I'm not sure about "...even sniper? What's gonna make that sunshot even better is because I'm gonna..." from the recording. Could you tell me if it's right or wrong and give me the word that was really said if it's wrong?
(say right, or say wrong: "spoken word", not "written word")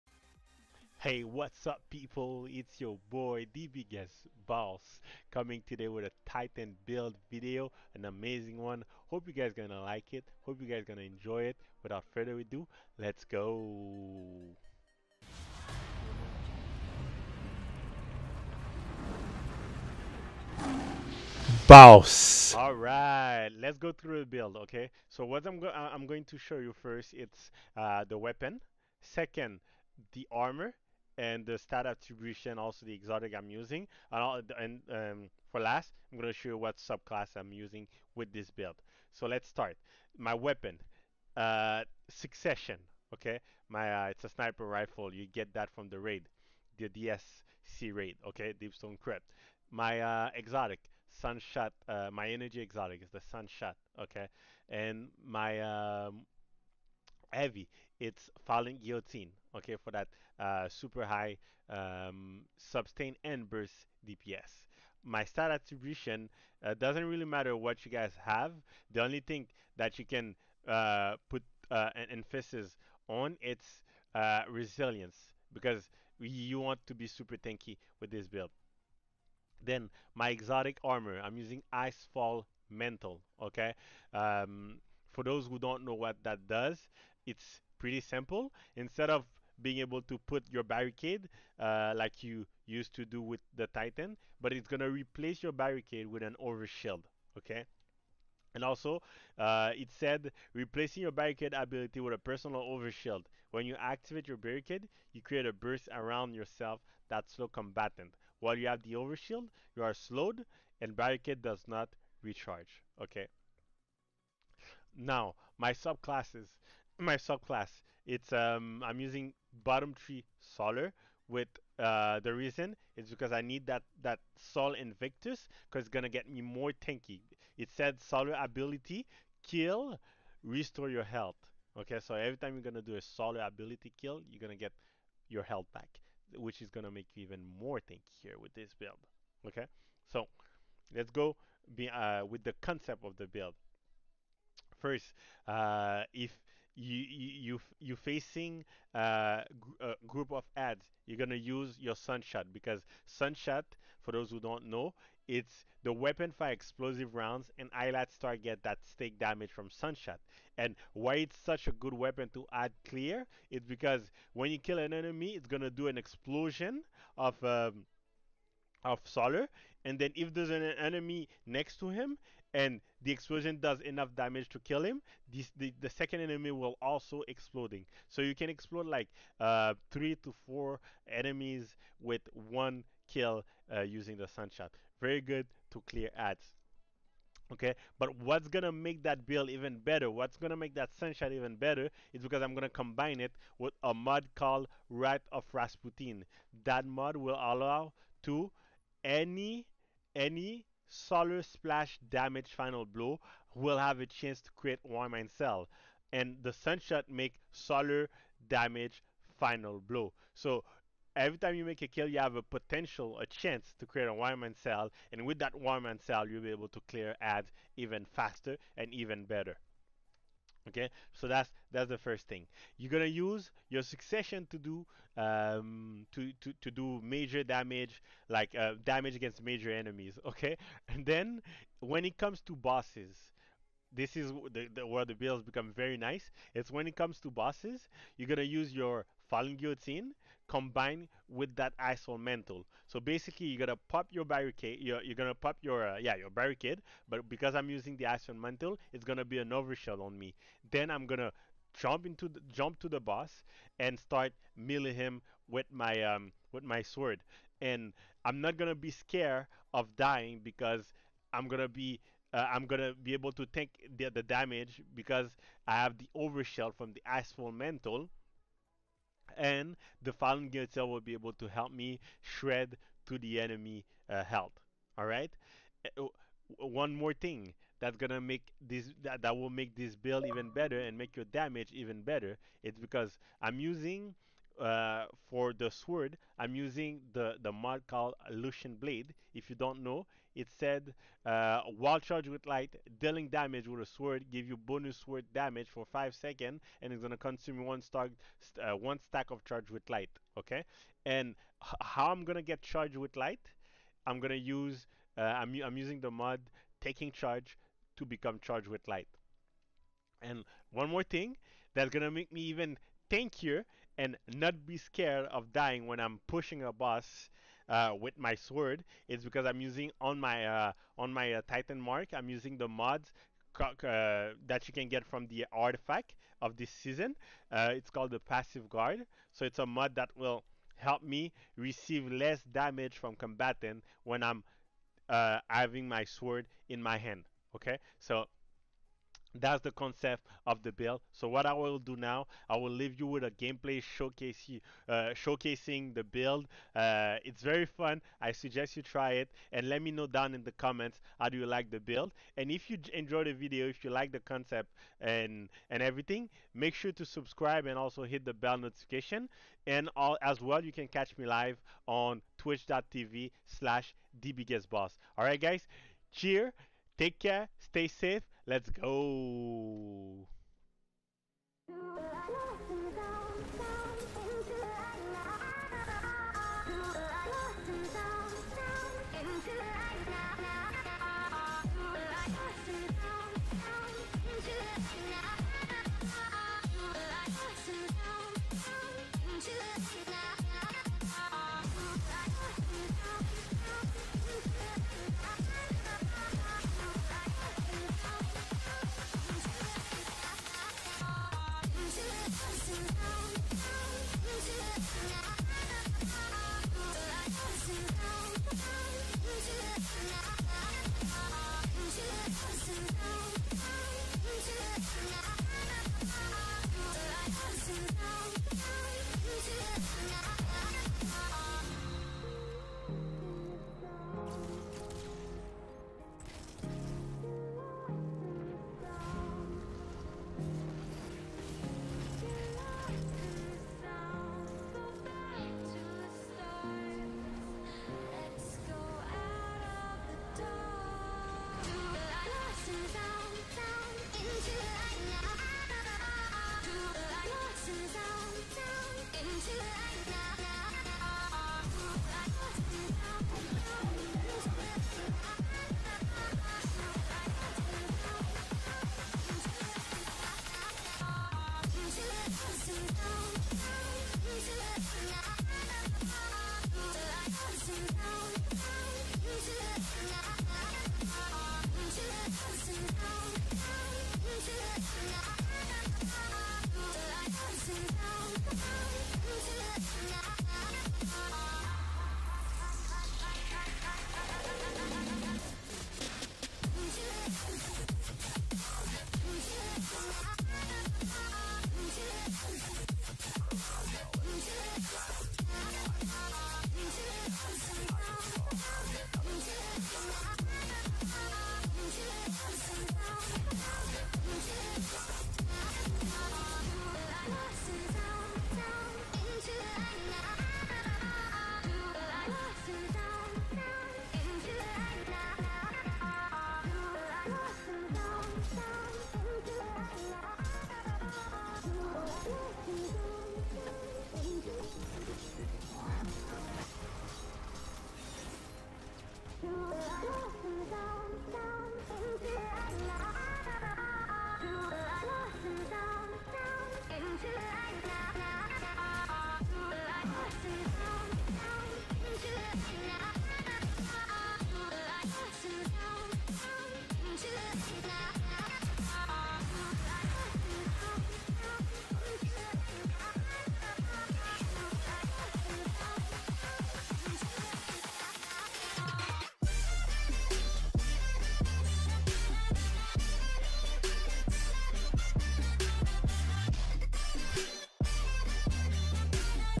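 wrong: "better", not "sniper".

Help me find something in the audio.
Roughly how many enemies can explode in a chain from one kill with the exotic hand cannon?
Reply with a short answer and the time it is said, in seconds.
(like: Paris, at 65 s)
3 to 4, at 179 s.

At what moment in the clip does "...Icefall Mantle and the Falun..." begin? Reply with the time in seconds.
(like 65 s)
267 s.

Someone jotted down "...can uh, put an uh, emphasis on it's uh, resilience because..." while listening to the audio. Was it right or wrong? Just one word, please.
right.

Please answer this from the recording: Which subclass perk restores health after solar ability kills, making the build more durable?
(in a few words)
Sol Invictus.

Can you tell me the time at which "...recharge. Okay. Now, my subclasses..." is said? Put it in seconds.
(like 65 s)
112 s.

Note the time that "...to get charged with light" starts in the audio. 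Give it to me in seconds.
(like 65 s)
302 s.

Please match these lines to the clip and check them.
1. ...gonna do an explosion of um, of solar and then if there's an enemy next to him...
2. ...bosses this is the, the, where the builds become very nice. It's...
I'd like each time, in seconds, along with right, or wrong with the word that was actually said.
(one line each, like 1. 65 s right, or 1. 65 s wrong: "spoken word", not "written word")
1. 165 s right
2. 232 s right.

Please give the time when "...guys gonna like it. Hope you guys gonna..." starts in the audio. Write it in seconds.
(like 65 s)
9 s.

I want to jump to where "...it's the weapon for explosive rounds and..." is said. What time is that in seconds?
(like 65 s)
155 s.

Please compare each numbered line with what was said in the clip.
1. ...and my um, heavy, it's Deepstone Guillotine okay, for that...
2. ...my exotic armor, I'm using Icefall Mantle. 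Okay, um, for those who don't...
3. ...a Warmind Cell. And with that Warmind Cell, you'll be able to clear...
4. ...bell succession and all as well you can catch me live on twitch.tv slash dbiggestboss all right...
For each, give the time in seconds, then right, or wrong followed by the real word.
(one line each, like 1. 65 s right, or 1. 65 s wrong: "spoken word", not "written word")
1. 54 s wrong: "Falling", not "Deepstone"
2. 80 s right
3. 214 s right
4. 358 s wrong: "notification", not "succession".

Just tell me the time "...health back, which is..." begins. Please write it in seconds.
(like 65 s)
135 s.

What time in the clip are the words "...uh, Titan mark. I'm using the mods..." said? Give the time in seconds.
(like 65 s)
321 s.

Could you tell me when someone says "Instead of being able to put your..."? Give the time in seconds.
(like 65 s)
88 s.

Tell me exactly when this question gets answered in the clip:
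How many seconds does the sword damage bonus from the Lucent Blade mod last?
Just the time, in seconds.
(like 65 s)
295 s.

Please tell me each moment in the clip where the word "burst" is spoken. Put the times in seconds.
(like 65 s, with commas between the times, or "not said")
63 s, 105 s.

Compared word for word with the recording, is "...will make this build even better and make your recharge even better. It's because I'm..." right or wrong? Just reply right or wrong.
wrong.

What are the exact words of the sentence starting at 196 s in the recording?
That mod will allow to any any Solar Splash damage final blow will have a chance to create Warmind Cell.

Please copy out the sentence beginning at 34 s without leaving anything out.
And, all, and um, for last, I'm going to show you what subclass I'm using with this build.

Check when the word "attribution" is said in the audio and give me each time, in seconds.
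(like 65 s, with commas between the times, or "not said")
31 s, 65 s.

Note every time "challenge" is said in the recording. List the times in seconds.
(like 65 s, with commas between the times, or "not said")
not said.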